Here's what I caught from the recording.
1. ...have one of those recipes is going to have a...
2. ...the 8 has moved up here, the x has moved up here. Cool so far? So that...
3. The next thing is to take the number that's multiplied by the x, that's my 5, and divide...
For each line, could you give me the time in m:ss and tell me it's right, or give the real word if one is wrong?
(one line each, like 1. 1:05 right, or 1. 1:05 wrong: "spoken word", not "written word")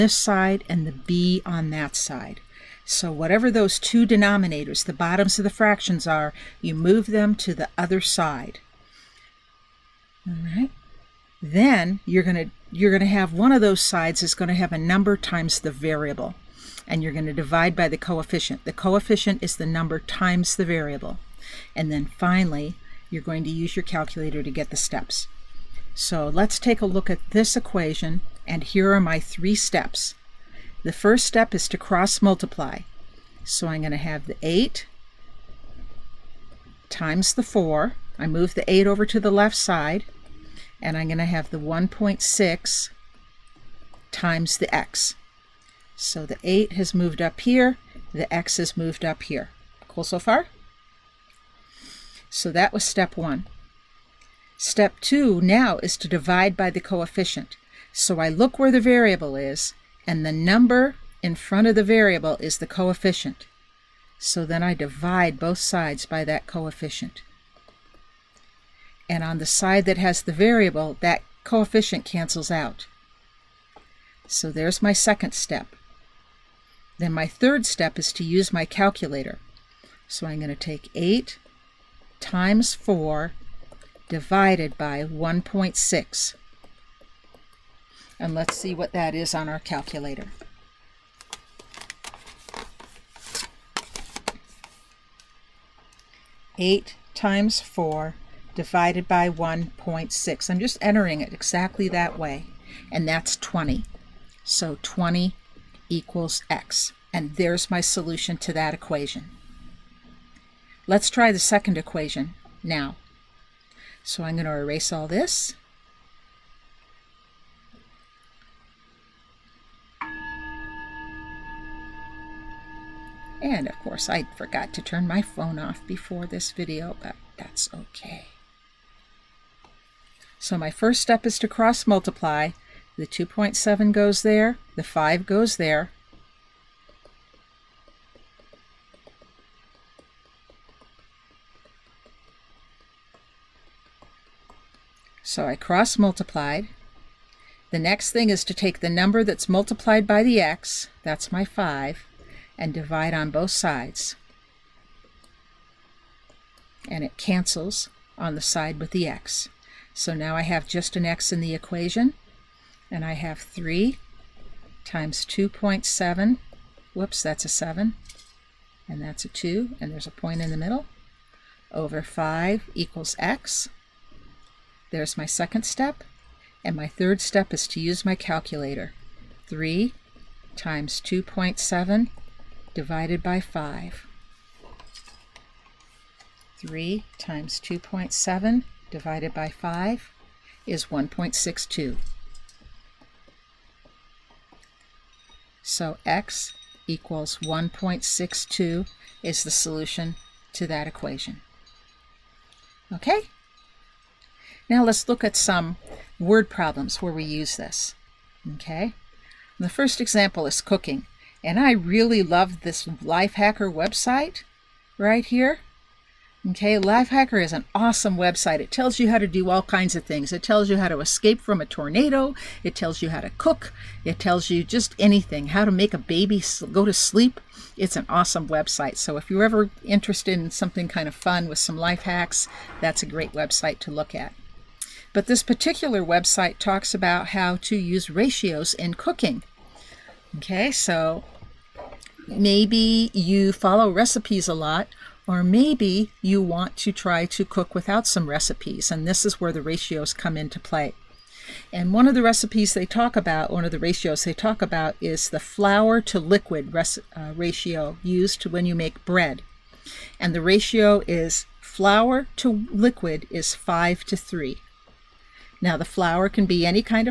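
1. 0:13 wrong: "sides", not "recipes"
2. 0:46 right
3. 2:27 right.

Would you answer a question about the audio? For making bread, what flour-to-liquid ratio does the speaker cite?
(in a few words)
5 to 3.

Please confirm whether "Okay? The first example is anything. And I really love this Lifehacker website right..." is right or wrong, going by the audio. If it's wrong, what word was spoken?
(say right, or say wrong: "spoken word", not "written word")
wrong: "cooking", not "anything".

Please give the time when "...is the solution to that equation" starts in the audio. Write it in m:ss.
3:19.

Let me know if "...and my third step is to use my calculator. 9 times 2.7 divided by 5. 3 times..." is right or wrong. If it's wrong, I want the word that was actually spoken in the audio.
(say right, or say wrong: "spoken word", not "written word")
wrong: "3", not "9".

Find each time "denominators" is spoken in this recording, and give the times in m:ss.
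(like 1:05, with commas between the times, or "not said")
0:04.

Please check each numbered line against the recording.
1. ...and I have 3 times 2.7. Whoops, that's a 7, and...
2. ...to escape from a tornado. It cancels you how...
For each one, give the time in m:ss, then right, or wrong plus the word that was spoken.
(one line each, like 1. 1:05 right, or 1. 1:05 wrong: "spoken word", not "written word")
1. 2:42 right
2. 3:40 wrong: "tells", not "cancels".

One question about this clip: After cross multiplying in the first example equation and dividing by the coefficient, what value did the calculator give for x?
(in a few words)
20.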